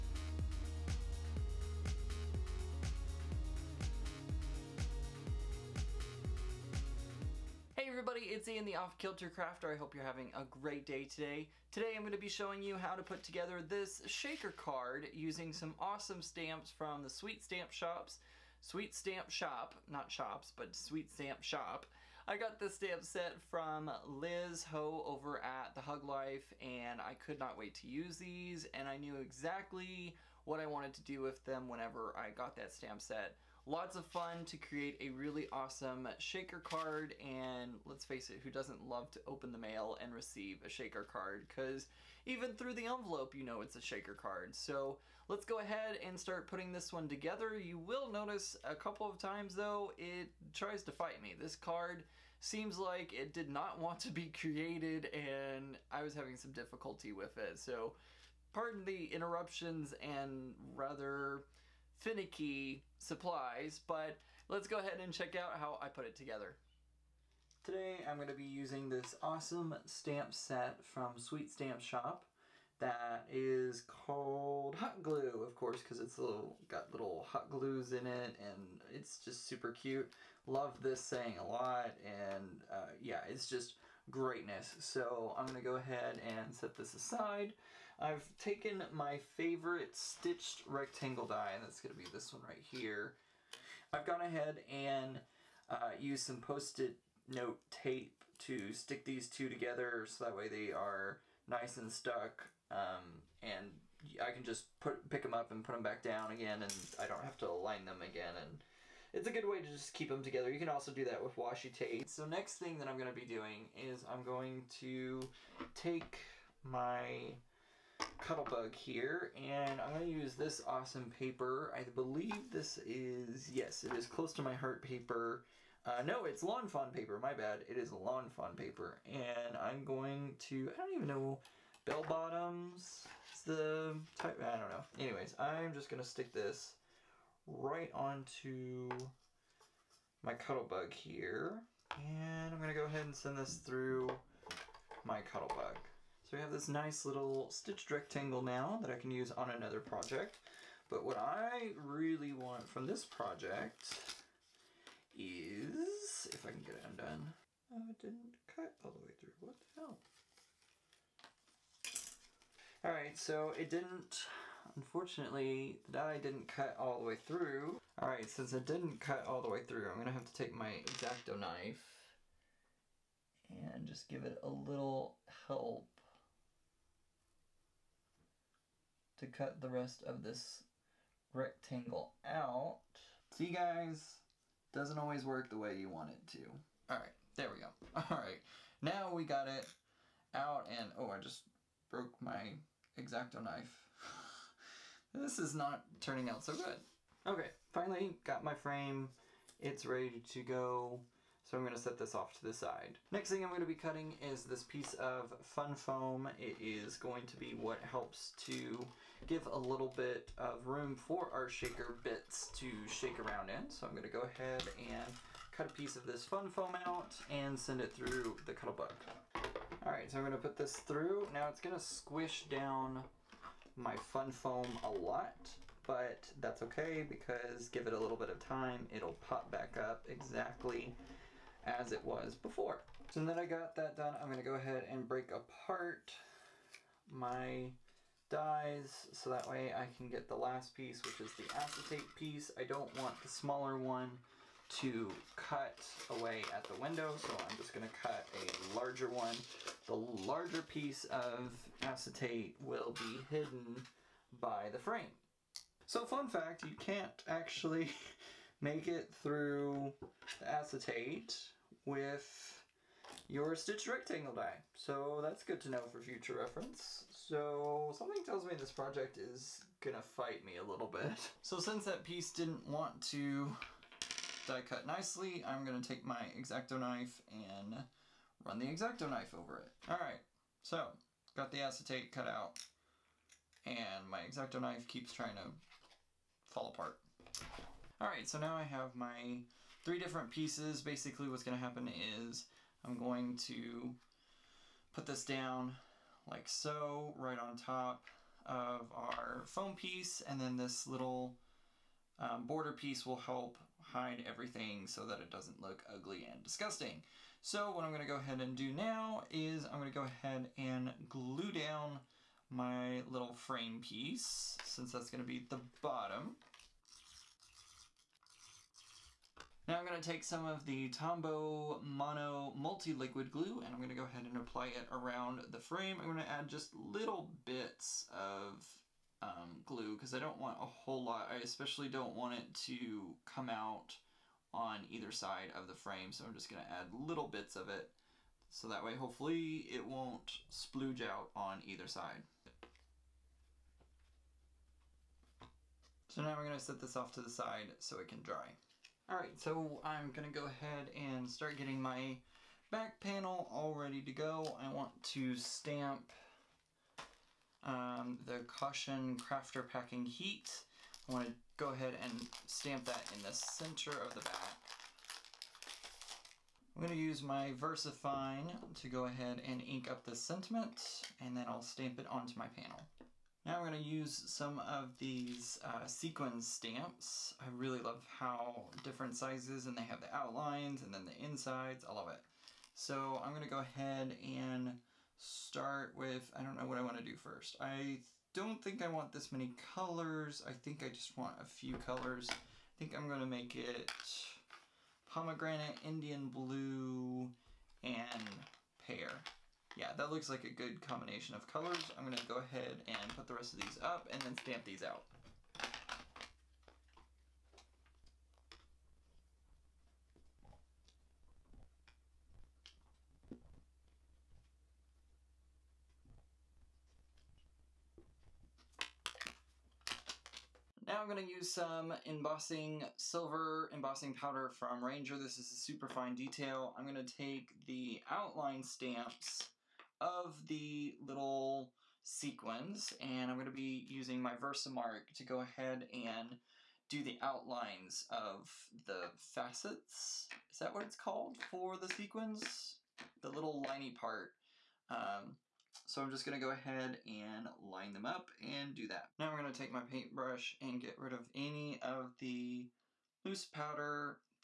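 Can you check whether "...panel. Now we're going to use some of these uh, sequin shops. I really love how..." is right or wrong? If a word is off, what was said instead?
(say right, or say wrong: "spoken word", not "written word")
wrong: "stamps", not "shops".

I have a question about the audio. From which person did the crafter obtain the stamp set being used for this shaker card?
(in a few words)
Liz Ho.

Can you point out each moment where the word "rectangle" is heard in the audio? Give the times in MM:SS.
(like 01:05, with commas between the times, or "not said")
01:30, 02:27, 03:01, 04:23.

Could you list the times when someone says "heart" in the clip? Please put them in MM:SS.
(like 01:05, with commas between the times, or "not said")
02:04.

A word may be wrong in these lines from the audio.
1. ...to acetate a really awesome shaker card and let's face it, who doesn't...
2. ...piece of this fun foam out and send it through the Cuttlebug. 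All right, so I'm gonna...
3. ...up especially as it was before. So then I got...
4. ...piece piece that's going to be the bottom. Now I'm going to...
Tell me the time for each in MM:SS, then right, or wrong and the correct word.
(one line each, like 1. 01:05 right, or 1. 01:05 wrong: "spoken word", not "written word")
1. 00:34 wrong: "create", not "acetate"
2. 03:35 right
3. 03:49 wrong: "exactly", not "especially"
4. 05:13 wrong: "since", not "piece".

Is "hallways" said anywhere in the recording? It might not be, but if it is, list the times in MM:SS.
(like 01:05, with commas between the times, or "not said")
not said.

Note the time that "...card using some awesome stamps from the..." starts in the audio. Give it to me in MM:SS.
00:14.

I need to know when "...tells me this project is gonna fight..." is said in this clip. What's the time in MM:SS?
04:28.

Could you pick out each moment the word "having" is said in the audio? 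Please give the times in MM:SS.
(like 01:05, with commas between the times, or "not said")
00:10, 00:56.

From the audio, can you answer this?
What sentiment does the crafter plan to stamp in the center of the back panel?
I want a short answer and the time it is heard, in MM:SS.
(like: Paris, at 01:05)
Caution Crafter Packing Heat, at 05:58.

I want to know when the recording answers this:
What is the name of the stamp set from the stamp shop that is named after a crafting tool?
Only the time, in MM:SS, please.
01:14.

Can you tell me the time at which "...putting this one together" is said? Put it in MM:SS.
00:46.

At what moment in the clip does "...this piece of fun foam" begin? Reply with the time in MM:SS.
03:24.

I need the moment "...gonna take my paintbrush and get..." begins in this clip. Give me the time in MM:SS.
07:29.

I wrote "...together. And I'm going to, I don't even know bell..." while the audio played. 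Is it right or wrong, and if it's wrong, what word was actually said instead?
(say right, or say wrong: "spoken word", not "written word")
wrong: "paper", not "together".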